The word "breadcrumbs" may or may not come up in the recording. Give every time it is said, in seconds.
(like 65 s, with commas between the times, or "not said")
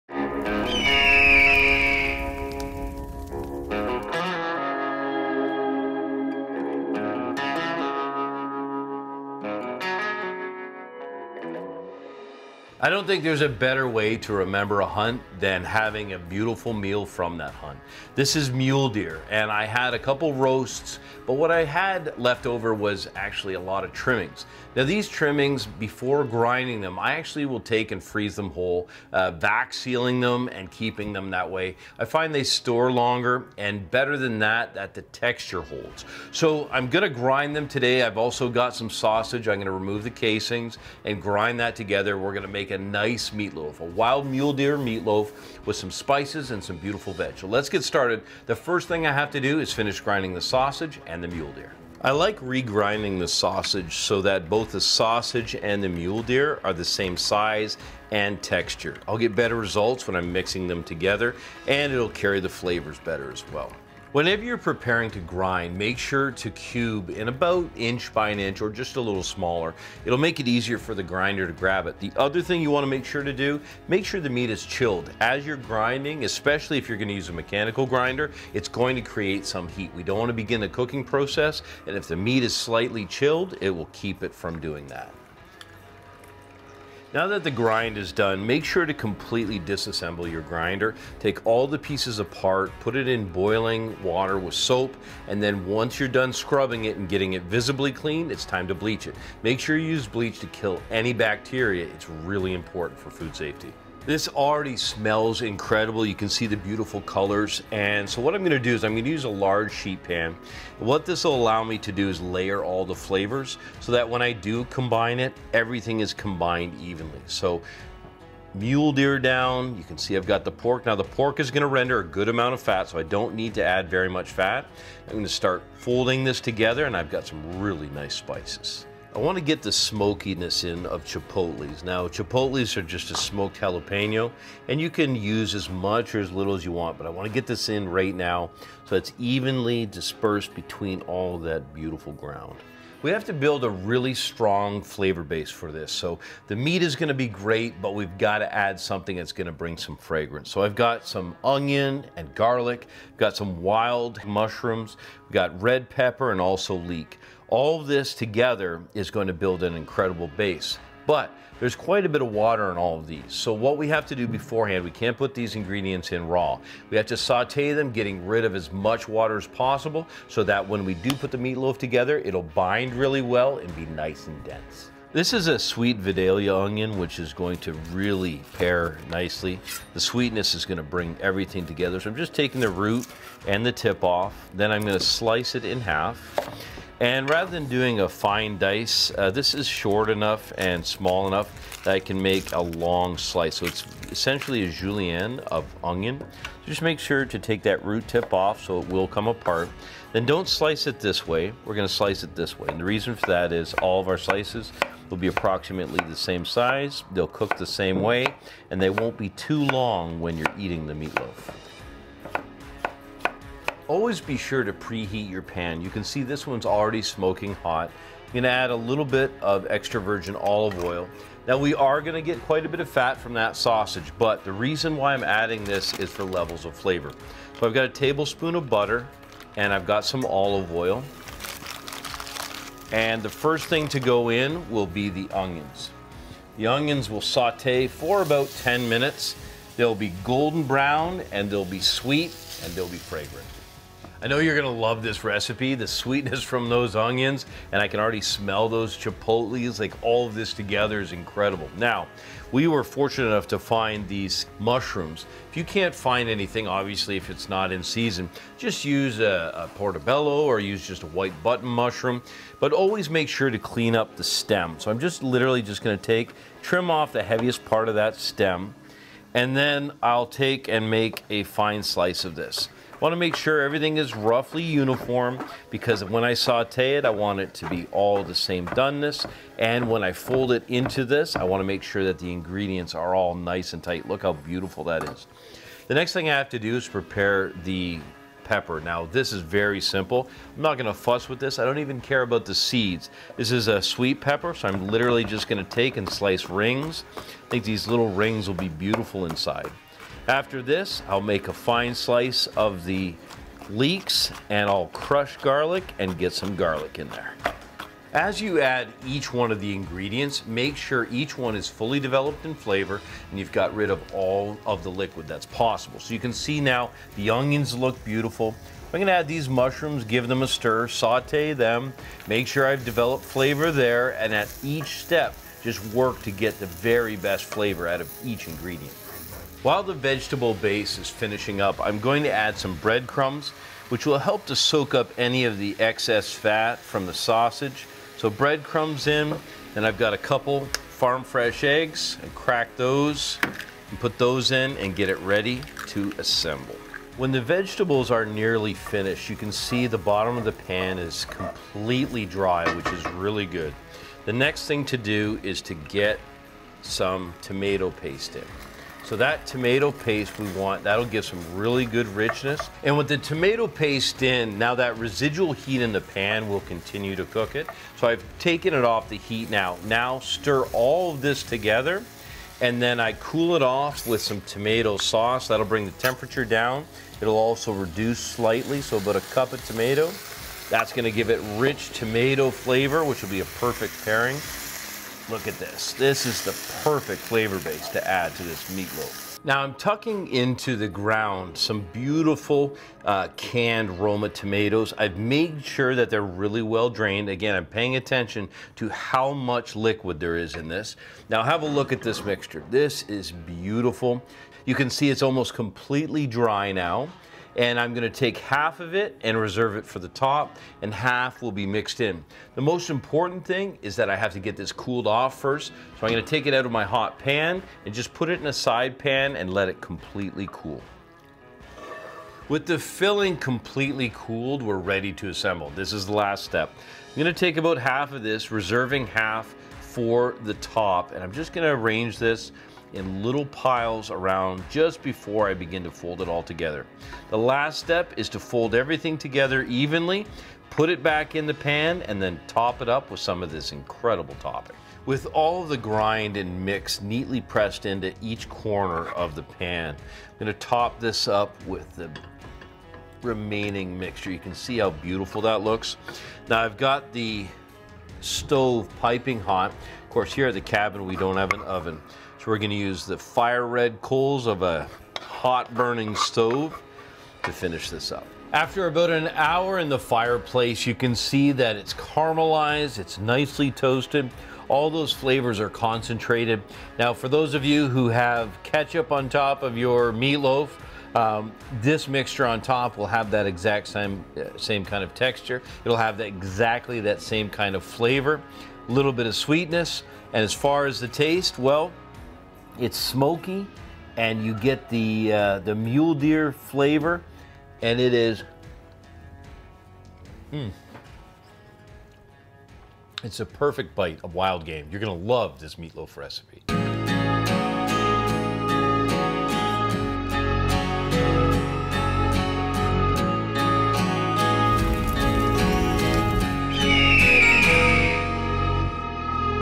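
332 s, 338 s.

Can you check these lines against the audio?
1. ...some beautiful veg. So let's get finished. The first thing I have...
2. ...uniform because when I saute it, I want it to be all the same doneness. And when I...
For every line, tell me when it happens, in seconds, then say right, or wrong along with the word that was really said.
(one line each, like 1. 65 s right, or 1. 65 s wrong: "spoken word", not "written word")
1. 46 s wrong: "started", not "finished"
2. 274 s right.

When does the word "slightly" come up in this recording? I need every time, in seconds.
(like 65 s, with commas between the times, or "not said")
82 s, 378 s.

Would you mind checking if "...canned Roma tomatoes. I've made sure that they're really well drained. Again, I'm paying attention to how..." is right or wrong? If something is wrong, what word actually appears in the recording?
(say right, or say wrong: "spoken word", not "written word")
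right.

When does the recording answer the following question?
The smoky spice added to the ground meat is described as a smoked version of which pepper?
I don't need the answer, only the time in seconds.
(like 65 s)
133 s.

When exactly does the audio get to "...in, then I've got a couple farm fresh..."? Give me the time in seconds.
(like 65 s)
339 s.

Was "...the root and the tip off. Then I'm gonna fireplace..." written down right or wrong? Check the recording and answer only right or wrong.
wrong.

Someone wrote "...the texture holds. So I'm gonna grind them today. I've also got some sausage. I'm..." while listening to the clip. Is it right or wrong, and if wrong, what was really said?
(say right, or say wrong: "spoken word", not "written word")
right.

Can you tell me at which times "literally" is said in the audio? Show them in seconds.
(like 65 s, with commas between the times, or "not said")
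265 s, 294 s.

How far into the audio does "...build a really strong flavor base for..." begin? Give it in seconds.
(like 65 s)
143 s.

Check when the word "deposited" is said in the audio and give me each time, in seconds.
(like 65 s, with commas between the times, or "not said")
not said.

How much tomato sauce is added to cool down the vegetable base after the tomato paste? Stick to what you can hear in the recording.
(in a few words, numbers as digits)
1 cup.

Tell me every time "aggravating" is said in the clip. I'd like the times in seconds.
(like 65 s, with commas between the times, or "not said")
not said.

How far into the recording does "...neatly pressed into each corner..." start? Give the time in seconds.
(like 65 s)
447 s.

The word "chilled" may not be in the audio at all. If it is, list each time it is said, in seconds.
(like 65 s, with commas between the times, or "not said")
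74 s, 83 s.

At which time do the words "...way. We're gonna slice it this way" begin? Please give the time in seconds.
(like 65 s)
201 s.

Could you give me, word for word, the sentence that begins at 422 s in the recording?
With the filling completely cooled, we're ready to assemble.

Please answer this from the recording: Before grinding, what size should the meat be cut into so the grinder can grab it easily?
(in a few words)
1 inch by 1 inch.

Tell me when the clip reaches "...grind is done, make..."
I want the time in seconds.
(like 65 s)
87 s.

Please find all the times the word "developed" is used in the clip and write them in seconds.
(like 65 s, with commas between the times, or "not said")
311 s, 322 s.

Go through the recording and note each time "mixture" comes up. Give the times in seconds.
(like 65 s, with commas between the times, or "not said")
402 s, 453 s, 482 s.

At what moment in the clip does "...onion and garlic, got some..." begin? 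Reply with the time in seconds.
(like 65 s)
151 s.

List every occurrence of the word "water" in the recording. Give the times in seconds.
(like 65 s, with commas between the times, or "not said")
94 s, 162 s, 169 s.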